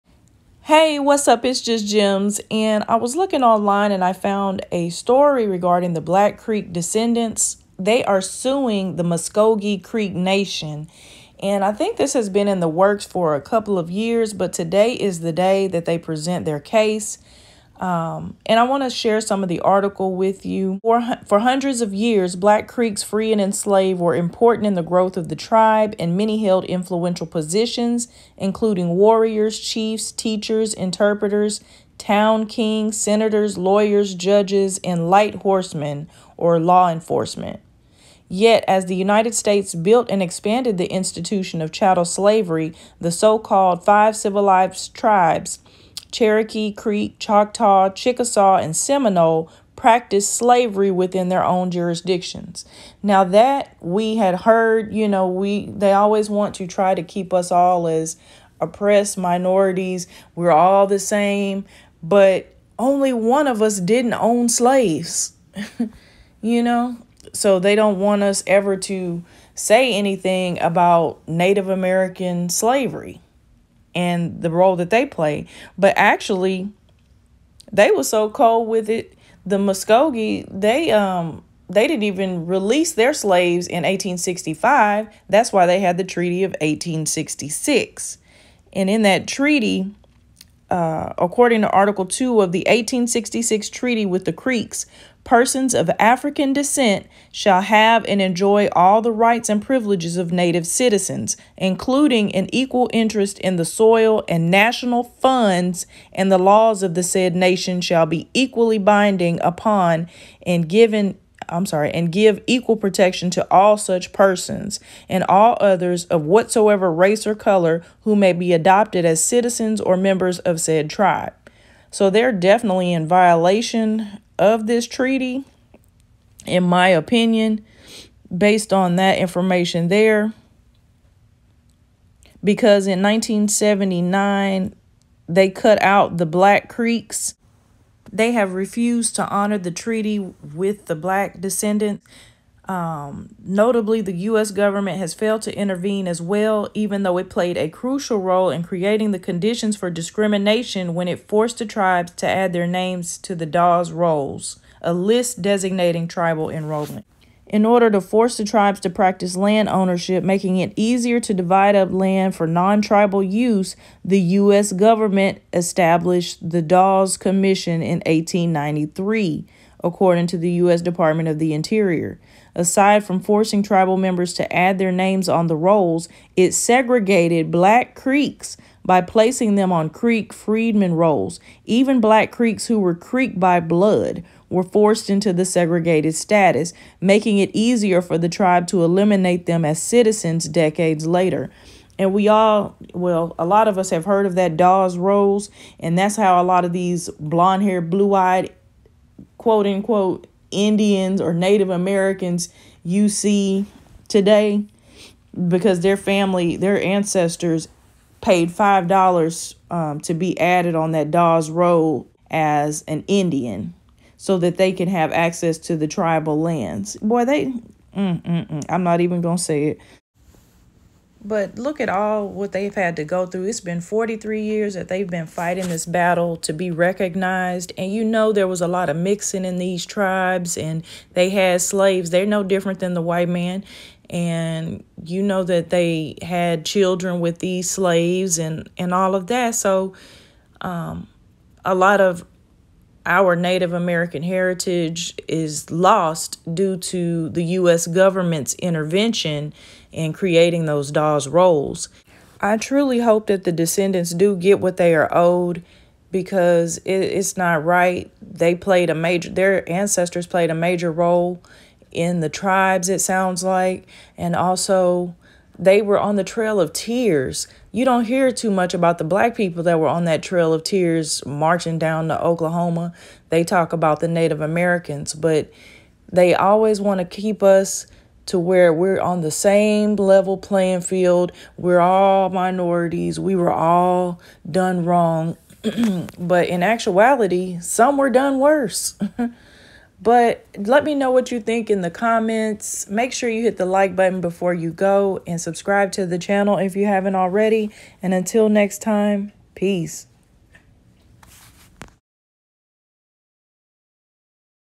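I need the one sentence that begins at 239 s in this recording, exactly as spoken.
So, um, a lot of our Native American heritage is lost due to the U.S.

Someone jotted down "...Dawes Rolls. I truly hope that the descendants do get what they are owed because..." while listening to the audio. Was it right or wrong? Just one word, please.
right.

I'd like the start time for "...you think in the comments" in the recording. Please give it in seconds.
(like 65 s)
291 s.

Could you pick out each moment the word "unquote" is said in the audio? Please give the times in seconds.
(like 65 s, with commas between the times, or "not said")
199 s.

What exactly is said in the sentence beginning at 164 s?
government established the Dawes Commission in 1893 according to the U.S.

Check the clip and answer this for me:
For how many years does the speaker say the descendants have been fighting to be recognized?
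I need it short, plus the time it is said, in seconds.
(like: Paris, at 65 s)
43 years, at 223 s.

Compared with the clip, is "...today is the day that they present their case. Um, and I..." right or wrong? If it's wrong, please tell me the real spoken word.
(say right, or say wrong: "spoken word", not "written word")
right.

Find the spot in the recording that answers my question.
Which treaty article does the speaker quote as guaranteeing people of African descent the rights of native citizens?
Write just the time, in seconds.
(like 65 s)
91 s.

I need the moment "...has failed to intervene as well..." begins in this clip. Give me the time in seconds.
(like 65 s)
144 s.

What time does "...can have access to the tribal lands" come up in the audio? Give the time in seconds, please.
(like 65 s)
214 s.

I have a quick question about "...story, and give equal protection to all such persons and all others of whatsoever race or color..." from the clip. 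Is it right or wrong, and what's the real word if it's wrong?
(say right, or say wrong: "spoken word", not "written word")
wrong: "sorry", not "story".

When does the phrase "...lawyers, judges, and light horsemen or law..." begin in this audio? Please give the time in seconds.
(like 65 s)
33 s.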